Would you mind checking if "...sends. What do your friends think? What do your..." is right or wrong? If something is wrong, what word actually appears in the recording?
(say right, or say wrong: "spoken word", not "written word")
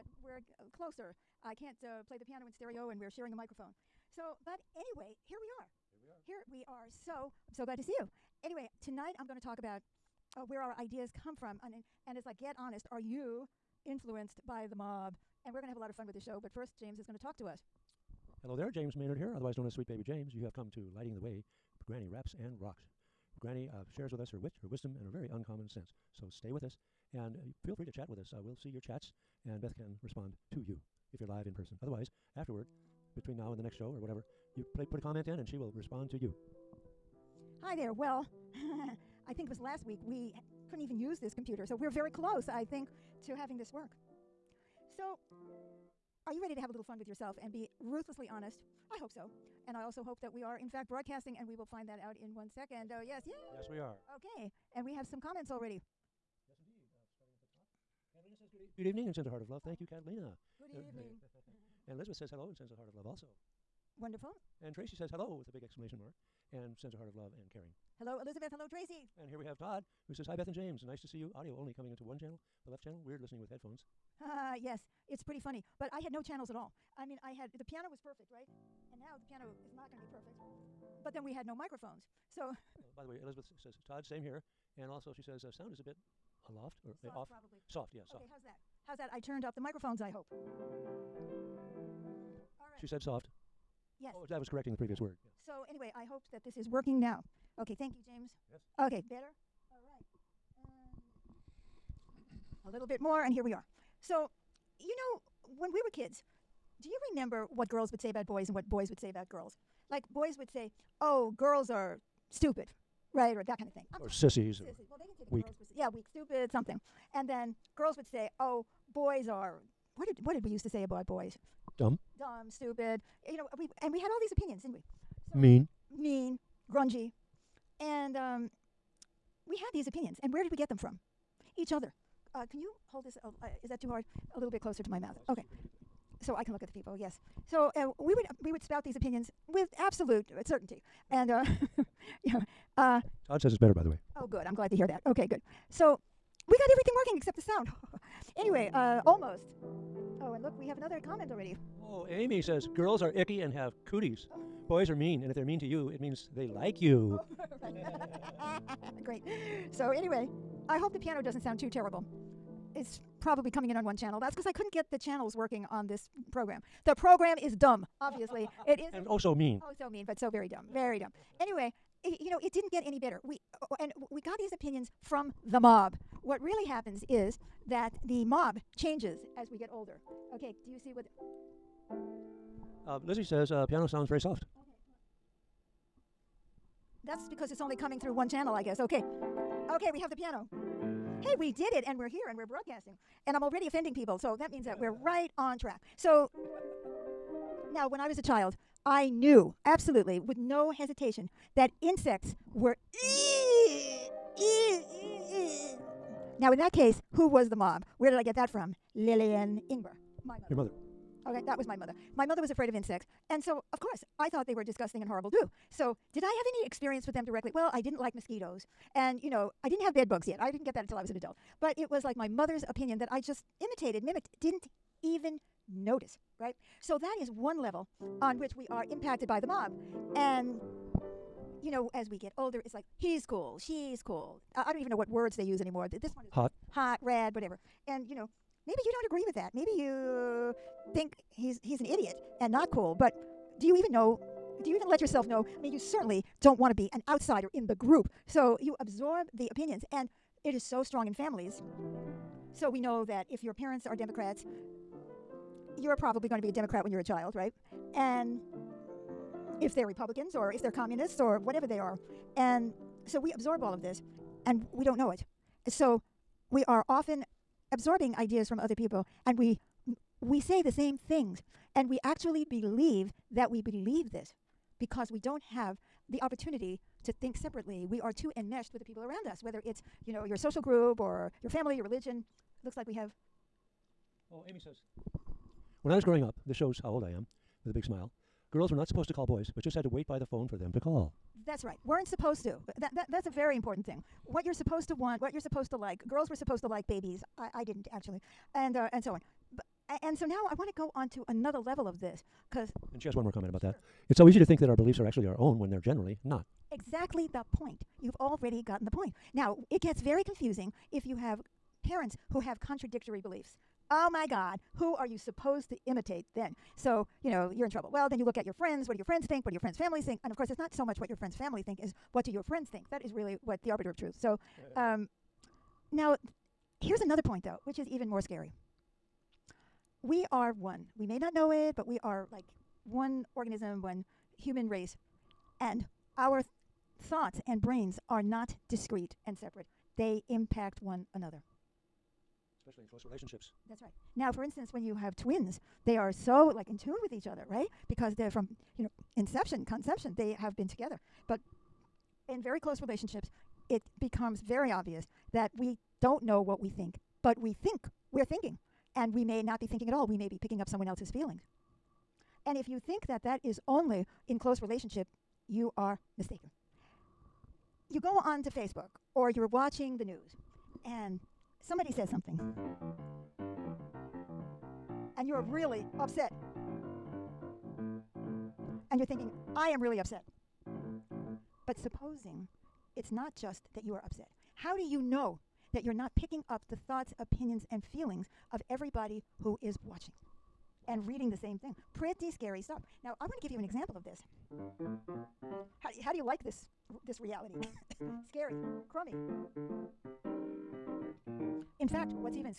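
wrong: "friends", not "sends".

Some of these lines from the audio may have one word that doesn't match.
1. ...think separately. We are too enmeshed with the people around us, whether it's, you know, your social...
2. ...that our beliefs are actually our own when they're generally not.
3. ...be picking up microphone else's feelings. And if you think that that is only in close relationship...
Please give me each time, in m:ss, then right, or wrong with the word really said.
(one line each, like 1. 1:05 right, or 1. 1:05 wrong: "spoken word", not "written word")
1. 4:37 right
2. 5:04 right
3. 6:00 wrong: "someone", not "microphone".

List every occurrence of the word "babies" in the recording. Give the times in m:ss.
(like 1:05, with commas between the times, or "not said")
4:56.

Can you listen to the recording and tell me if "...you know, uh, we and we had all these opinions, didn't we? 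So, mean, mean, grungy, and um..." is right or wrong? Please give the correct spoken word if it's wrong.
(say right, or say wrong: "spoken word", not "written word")
right.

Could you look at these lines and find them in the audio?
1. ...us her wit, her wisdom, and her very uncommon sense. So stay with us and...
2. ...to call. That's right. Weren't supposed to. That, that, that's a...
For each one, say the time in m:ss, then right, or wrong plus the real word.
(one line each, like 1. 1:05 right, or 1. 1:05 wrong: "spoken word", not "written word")
1. 0:24 right
2. 4:50 right.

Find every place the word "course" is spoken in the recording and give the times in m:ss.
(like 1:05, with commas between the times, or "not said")
3:33, 5:20.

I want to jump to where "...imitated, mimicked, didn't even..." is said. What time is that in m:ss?
3:43.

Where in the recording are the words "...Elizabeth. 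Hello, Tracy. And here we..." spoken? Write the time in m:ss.
1:08.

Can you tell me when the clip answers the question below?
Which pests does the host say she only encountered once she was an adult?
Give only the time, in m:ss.
3:39.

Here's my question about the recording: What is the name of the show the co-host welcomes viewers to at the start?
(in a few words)
Lighting the Way, Granny Raps and Rocks.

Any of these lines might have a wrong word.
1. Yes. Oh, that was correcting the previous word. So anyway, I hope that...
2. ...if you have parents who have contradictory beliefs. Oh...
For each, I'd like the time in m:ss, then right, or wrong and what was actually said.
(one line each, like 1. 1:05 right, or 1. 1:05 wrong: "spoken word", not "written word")
1. 1:33 right
2. 5:10 right.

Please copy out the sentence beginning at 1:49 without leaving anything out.
Like, boys would say, oh, girls are stupid Right, or that kind of thing.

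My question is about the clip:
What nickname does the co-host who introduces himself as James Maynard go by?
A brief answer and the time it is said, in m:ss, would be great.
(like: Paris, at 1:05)
Sweet Baby James, at 0:19.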